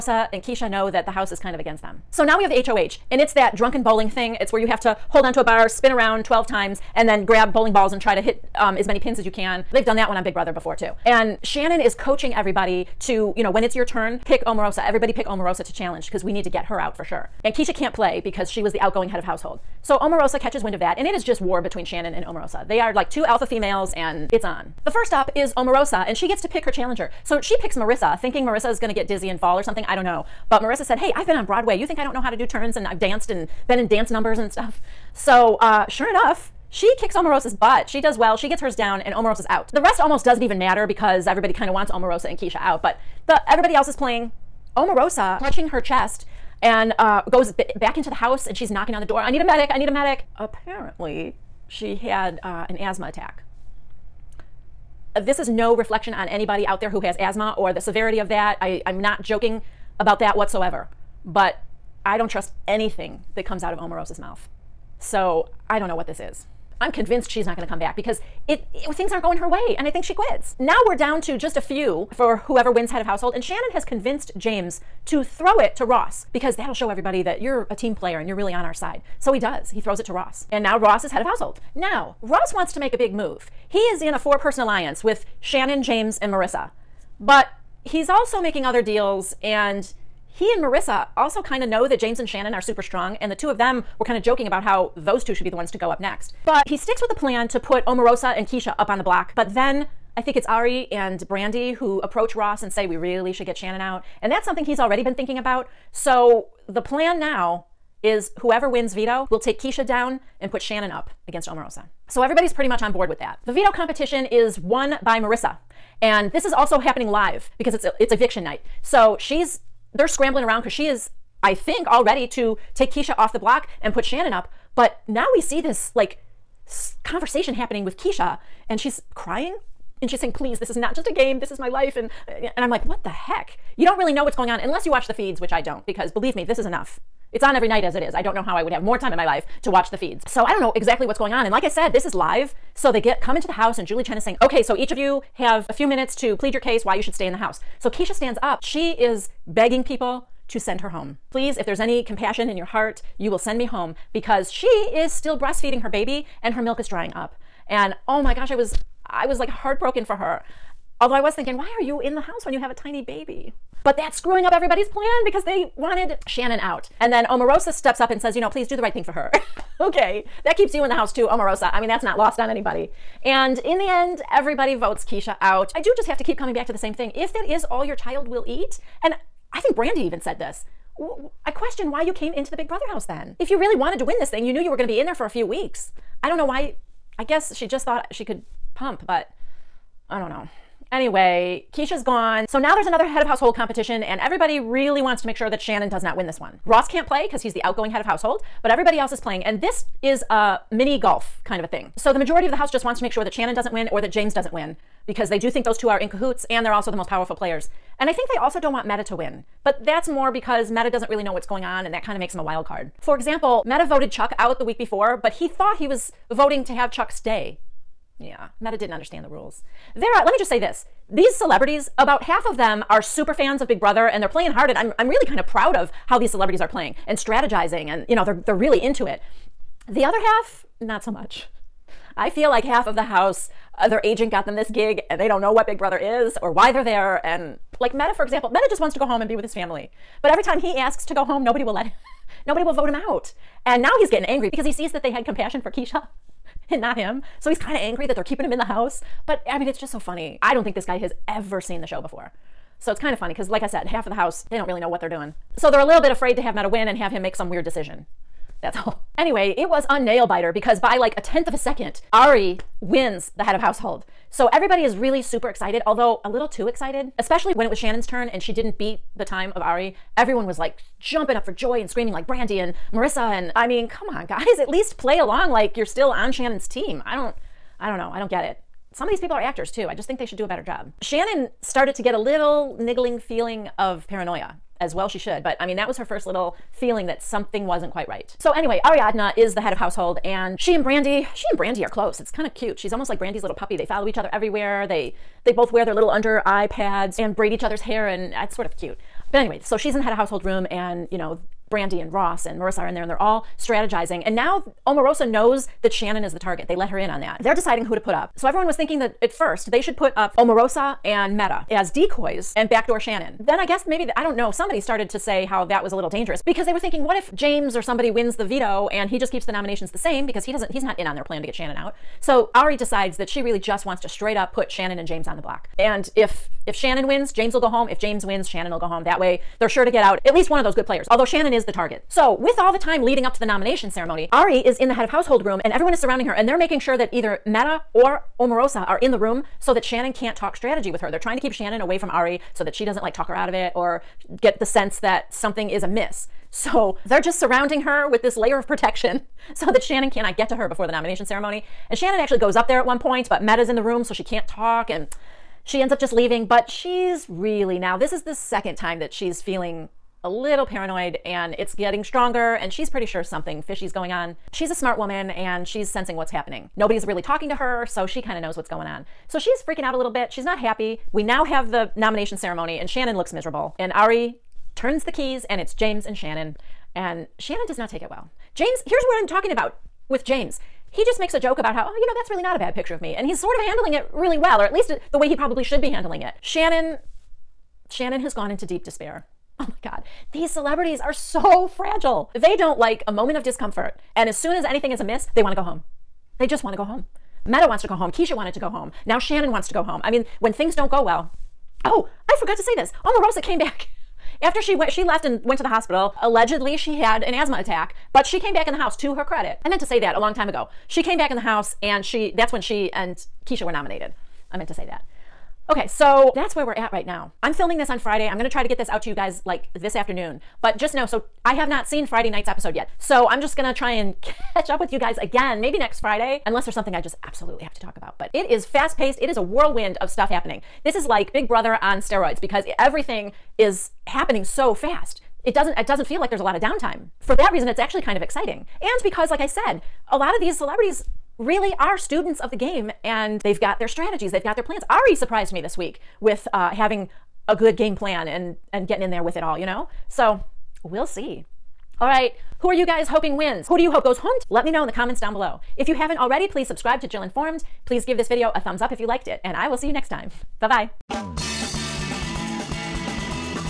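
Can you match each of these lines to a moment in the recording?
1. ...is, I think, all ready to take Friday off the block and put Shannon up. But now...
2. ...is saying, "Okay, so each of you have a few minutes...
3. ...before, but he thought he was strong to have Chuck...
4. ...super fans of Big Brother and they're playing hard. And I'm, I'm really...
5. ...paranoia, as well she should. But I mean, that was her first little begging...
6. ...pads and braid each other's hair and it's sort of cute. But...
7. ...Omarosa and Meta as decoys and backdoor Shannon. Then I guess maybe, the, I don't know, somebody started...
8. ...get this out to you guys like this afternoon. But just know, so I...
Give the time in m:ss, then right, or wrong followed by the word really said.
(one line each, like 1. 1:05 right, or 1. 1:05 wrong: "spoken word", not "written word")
1. 2:00 wrong: "Keisha", not "Friday"
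2. 2:24 right
3. 3:34 wrong: "voting", not "strong"
4. 3:42 right
5. 4:44 wrong: "feeling", not "begging"
6. 4:56 right
7. 5:10 right
8. 6:58 right.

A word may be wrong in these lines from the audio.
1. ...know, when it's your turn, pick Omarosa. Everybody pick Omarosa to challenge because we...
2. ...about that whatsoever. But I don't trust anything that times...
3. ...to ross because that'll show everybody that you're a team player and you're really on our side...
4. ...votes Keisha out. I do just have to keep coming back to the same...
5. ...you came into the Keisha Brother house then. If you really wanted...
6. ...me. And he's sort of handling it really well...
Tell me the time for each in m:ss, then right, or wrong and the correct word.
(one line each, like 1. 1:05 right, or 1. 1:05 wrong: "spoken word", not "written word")
1. 0:13 right
2. 0:59 wrong: "comes", not "times"
3. 1:15 right
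4. 2:54 right
5. 3:02 wrong: "Big", not "Keisha"
6. 6:22 right.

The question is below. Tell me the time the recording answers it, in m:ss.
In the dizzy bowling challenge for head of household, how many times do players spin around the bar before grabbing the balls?
0:06.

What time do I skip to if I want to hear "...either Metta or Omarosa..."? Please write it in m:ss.
5:37.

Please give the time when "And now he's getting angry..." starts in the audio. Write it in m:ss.
4:03.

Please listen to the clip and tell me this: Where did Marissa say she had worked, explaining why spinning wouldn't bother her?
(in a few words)
Broadway.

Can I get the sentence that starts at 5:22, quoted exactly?
So Ari decides that she really just wants to straight up put Shannon and James on the block.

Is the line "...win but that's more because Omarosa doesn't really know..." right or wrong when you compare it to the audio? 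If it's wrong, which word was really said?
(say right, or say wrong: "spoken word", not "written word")
wrong: "Metta", not "Omarosa".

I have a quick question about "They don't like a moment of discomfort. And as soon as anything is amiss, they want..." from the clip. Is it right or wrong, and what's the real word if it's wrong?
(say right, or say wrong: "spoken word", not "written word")
right.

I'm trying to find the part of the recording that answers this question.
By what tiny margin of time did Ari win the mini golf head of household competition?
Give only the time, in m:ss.
4:21.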